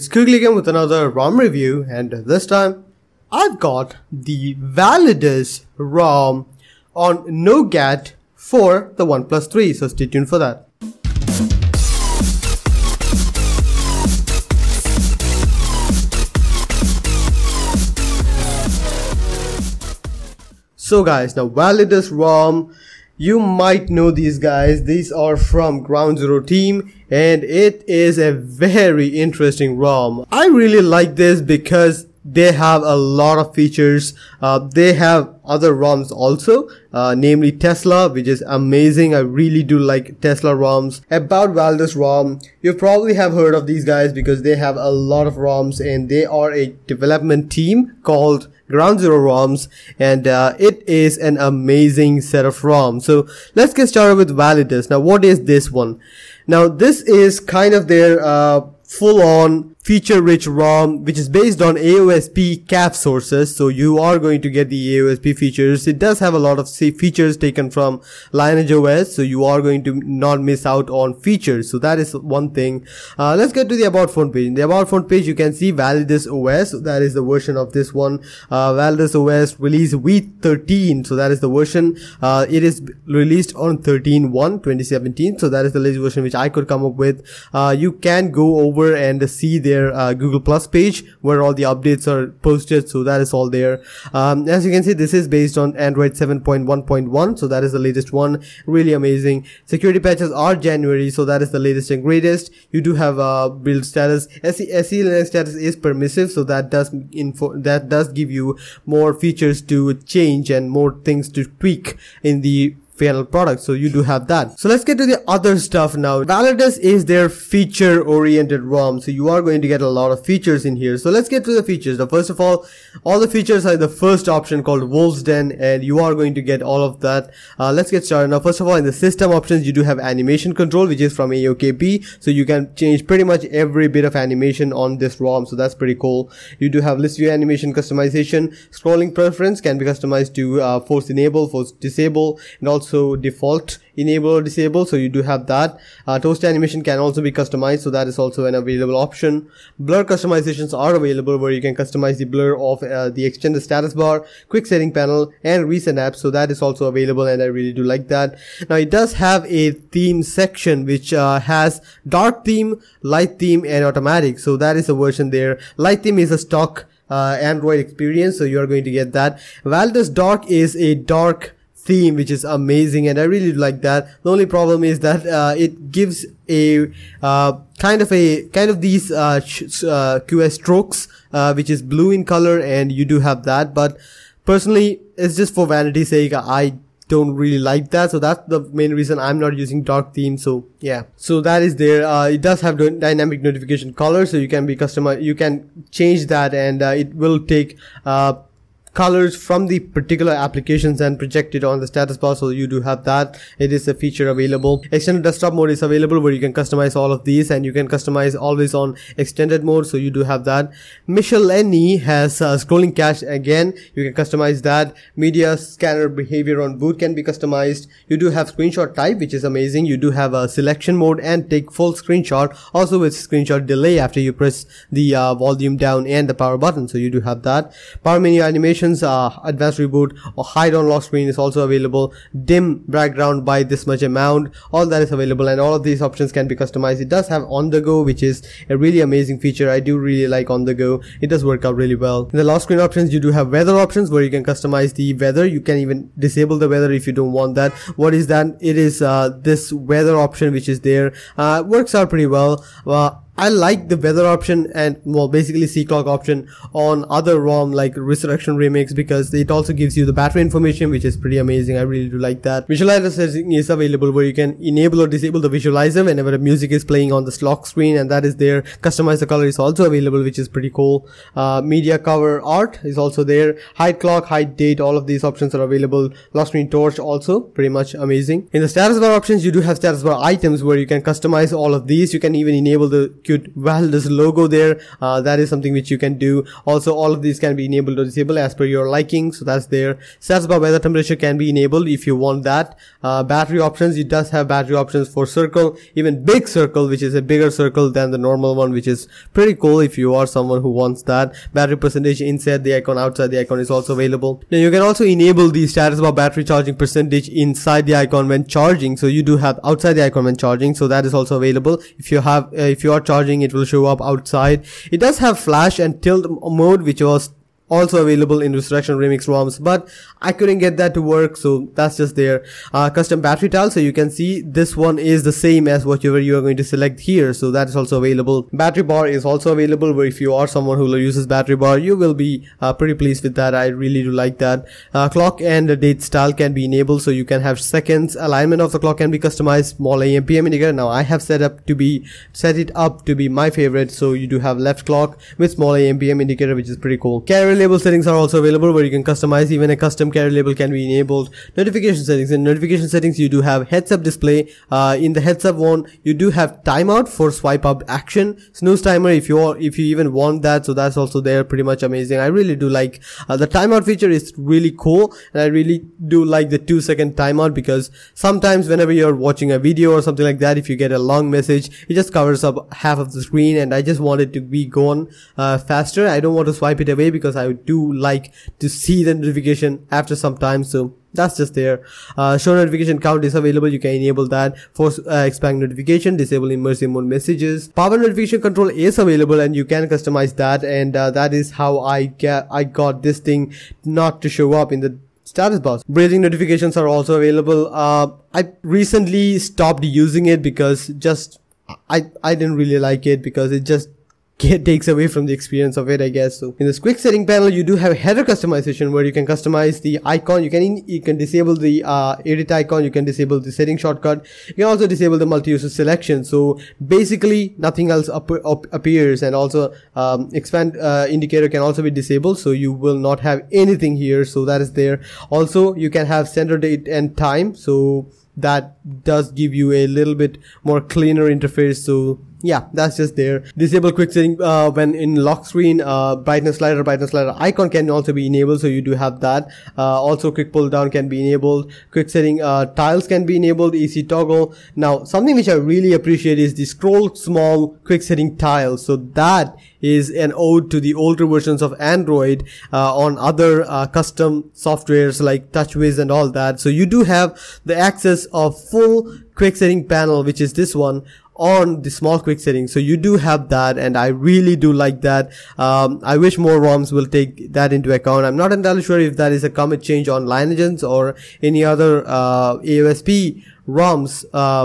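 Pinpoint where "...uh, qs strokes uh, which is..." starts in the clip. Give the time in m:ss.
2:59.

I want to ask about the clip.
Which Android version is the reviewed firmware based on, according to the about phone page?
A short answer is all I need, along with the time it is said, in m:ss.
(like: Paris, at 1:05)
7.1.1, at 1:35.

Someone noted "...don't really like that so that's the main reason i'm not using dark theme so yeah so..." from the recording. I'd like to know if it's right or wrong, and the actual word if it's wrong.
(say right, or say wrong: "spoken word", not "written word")
right.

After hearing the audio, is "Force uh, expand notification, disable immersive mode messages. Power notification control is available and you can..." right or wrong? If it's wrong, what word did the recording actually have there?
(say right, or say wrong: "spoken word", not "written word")
right.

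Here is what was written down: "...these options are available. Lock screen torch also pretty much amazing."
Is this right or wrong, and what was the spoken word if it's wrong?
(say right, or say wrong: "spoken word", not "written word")
right.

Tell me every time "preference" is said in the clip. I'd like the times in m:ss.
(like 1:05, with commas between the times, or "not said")
2:19.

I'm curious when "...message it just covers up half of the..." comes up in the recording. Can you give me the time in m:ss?
6:11.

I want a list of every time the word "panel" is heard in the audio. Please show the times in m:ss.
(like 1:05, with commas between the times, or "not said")
2:34, 6:47, 7:39.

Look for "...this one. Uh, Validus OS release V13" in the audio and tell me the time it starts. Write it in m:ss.
1:17.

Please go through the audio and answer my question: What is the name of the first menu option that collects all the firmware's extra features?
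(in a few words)
Wolves Den.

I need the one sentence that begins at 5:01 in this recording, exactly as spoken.
Battery percentage inside the icon, outside the icon is also available.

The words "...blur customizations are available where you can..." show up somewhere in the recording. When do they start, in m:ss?
2:29.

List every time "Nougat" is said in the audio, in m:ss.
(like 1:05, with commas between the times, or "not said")
0:07.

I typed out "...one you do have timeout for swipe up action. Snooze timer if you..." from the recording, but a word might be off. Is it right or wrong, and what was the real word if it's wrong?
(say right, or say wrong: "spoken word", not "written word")
right.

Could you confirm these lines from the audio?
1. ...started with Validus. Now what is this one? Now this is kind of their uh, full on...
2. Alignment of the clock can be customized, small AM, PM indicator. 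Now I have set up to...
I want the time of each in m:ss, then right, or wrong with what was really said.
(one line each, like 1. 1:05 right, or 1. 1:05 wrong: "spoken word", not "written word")
1. 0:53 right
2. 5:38 right.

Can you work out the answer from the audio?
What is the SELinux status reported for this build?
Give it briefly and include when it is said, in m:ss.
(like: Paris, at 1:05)
Permissive, at 1:45.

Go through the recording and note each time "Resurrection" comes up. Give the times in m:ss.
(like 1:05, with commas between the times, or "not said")
4:17, 5:18.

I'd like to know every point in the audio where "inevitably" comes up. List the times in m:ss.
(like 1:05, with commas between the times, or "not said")
not said.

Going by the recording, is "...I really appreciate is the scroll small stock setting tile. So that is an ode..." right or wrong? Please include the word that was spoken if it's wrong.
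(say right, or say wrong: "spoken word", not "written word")
wrong: "quick", not "stock".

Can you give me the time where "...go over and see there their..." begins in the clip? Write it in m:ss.
1:28.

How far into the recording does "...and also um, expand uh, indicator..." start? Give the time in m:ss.
6:59.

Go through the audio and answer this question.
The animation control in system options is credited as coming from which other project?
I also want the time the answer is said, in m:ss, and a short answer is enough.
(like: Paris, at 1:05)
AOKP, at 2:11.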